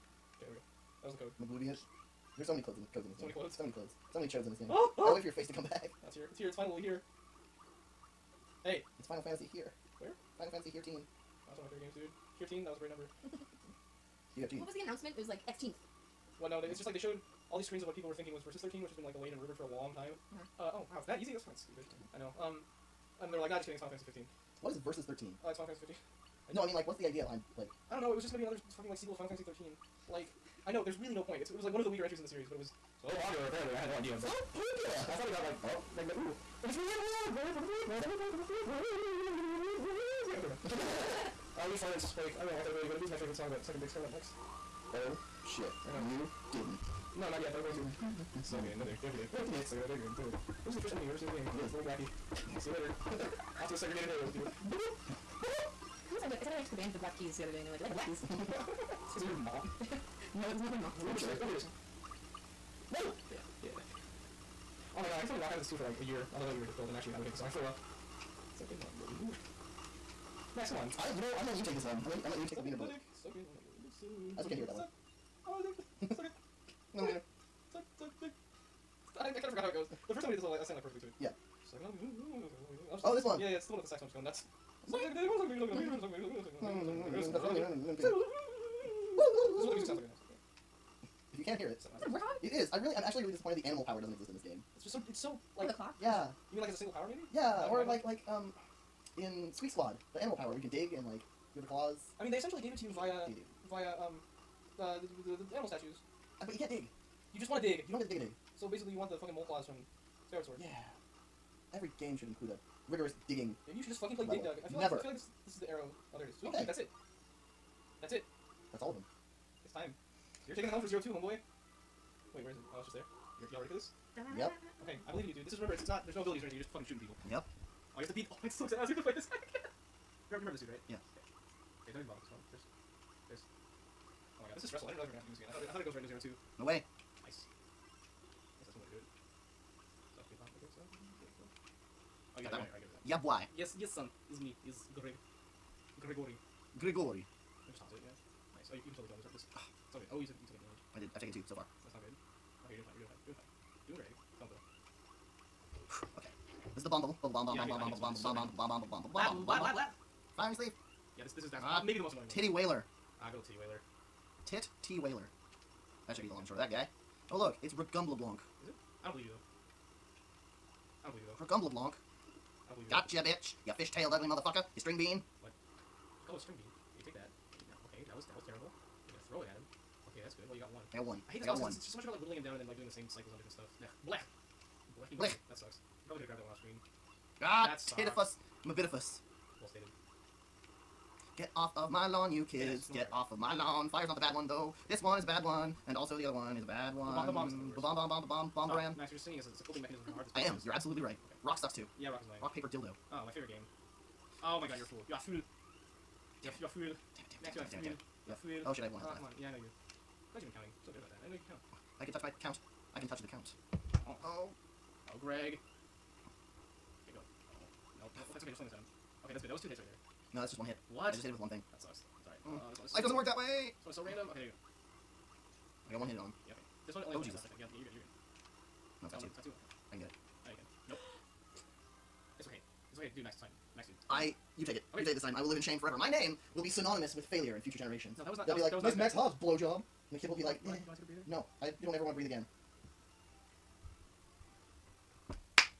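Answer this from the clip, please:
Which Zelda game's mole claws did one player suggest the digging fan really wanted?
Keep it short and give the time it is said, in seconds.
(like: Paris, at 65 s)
Skyward Sword, at 110 s.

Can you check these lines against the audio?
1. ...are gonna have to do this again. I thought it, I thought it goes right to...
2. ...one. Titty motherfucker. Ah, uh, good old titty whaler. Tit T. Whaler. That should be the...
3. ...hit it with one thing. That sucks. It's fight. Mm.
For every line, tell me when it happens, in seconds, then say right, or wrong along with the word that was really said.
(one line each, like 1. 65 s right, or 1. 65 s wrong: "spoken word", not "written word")
1. 135 s right
2. 162 s wrong: "whaler", not "motherfucker"
3. 221 s wrong: "alright", not "fight".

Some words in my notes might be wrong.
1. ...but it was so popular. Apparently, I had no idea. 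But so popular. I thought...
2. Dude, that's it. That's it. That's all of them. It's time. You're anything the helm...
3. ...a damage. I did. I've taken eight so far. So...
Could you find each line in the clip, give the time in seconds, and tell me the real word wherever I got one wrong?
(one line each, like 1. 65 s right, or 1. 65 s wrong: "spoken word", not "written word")
1. 32 s right
2. 116 s wrong: "taking", not "anything"
3. 150 s wrong: "two", not "eight".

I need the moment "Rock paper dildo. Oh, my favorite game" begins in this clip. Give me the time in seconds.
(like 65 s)
202 s.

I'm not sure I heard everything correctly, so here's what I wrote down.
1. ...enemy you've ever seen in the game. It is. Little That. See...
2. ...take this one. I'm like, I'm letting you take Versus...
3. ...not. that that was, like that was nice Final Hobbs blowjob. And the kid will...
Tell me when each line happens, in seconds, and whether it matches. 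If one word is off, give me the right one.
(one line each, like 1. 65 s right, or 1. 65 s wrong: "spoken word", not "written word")
1. 50 s wrong: "Blackie", not "That"
2. 71 s wrong: "Suck", not "Versus"
3. 238 s wrong: "Max", not "Final".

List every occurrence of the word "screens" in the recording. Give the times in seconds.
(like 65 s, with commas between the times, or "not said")
17 s, 186 s.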